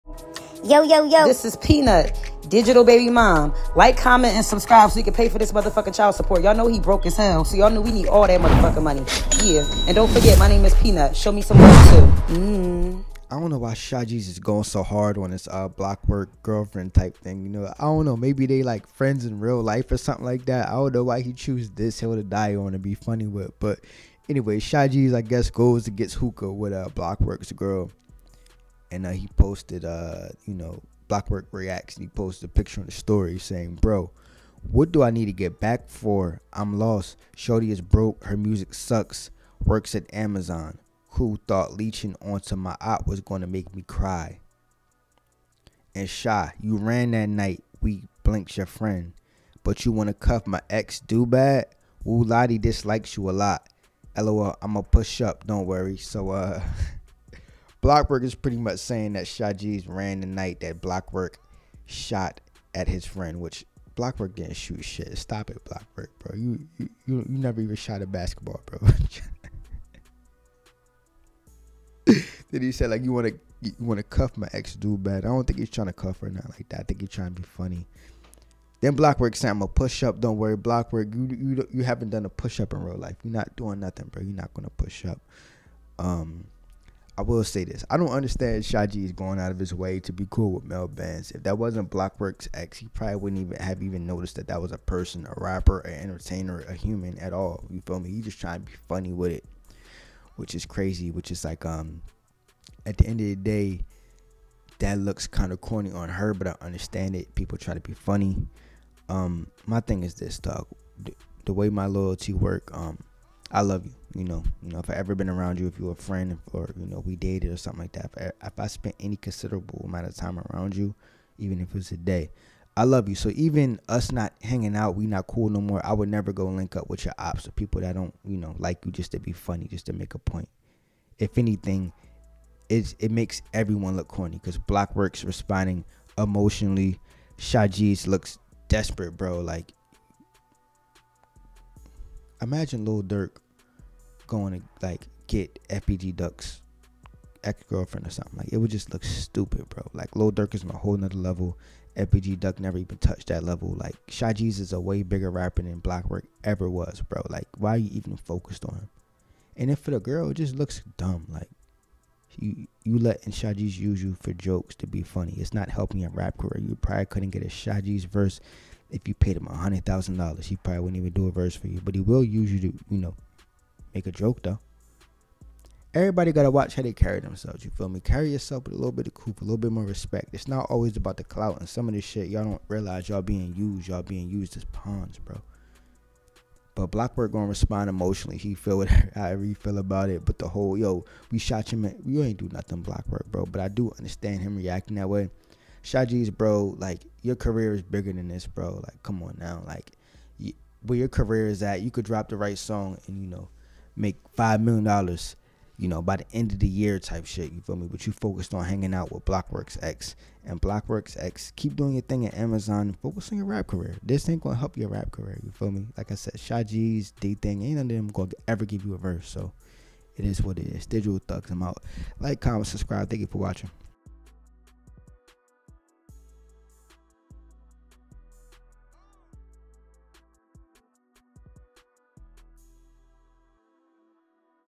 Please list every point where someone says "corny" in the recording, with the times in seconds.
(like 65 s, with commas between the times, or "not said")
105 s, 134 s.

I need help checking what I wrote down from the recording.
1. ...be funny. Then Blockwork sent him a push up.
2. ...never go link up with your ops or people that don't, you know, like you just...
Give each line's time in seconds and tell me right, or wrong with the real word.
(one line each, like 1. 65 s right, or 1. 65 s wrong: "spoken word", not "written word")
1. 77 s right
2. 126 s right.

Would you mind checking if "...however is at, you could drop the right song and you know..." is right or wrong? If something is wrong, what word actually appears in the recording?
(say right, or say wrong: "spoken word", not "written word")
wrong: "career", not "however".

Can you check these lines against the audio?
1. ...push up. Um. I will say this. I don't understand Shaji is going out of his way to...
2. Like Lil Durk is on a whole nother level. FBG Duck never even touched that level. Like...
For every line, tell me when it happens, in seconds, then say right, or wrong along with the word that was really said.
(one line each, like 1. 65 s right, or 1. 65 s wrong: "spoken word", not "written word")
1. 84 s right
2. 149 s right.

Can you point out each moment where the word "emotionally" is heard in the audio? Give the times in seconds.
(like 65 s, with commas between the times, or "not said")
136 s, 187 s.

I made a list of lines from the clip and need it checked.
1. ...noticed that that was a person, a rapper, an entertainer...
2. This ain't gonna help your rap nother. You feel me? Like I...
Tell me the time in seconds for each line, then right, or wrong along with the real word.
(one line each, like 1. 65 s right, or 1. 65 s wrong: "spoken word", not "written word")
1. 94 s right
2. 214 s wrong: "career", not "nother".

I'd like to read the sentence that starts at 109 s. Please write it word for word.
Um, my thing is this, dog.